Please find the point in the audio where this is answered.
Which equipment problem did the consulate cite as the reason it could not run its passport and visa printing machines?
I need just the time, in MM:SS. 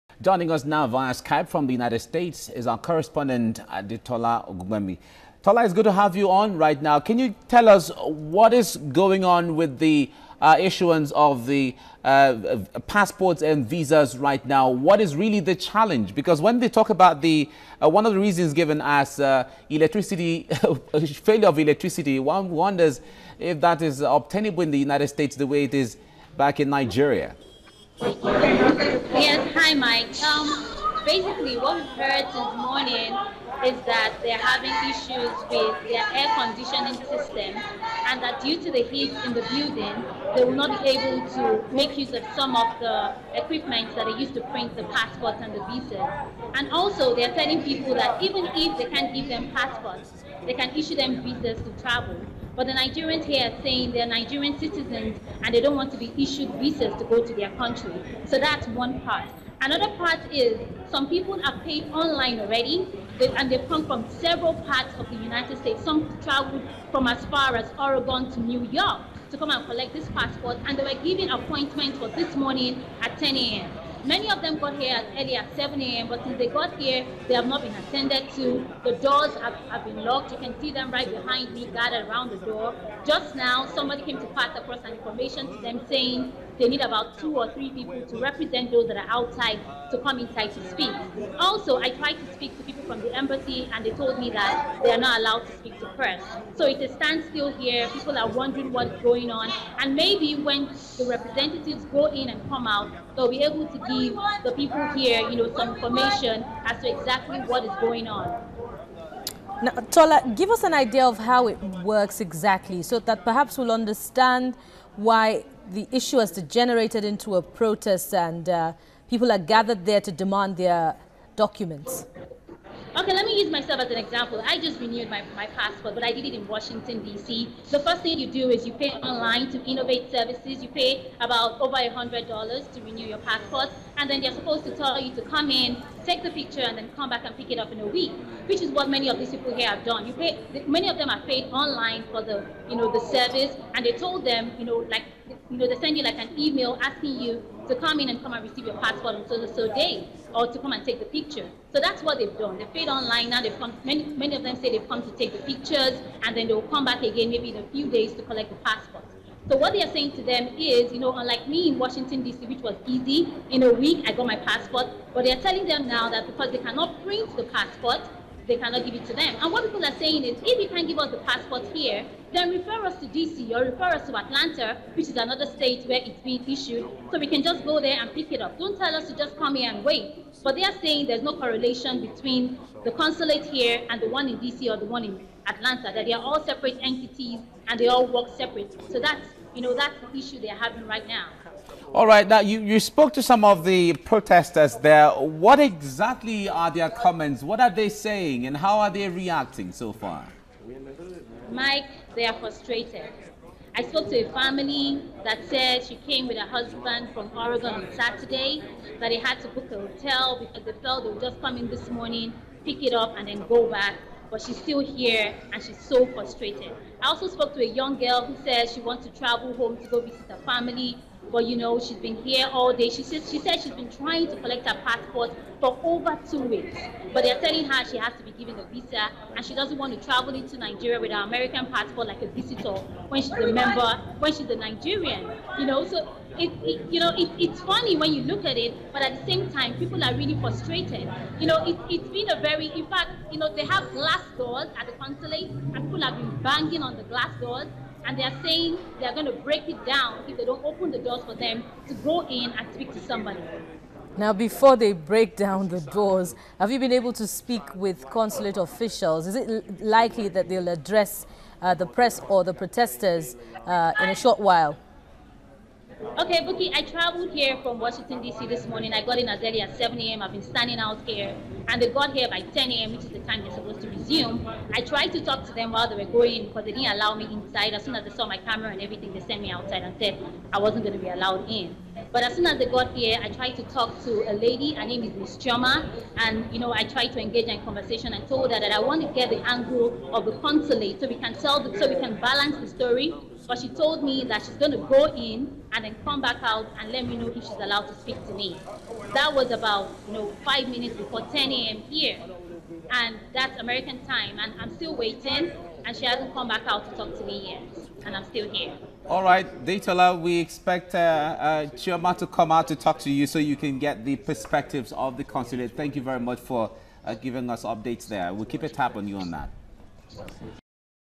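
00:36.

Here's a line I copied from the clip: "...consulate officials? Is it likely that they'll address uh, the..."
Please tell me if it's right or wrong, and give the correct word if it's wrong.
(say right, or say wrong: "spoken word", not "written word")
right.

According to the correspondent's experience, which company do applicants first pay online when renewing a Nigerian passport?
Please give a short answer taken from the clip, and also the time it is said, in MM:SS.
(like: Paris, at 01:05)
Innovate Services, at 02:09.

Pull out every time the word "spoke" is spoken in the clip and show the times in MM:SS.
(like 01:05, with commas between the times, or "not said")
03:12, 03:23, 03:37.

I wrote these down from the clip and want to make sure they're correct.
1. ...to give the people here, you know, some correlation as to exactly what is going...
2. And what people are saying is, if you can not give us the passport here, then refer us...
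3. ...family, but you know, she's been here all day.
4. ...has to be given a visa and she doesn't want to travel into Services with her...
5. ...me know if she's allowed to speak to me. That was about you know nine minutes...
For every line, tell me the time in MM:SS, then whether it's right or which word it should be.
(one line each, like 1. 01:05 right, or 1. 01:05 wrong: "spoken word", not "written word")
1. 01:43 wrong: "information", not "correlation"
2. 02:49 right
3. 03:40 right
4. 03:47 wrong: "Nigeria", not "Services"
5. 04:57 wrong: "five", not "nine".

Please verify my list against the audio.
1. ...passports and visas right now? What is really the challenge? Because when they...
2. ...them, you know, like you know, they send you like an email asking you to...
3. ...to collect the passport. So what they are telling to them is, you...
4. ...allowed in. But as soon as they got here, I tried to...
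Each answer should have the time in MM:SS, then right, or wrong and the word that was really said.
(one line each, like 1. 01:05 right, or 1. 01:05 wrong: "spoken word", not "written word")
1. 00:12 right
2. 02:24 right
3. 02:38 wrong: "saying", not "telling"
4. 04:41 right.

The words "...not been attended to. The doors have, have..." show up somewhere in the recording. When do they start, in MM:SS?
01:17.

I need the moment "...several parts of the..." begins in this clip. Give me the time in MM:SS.
01:04.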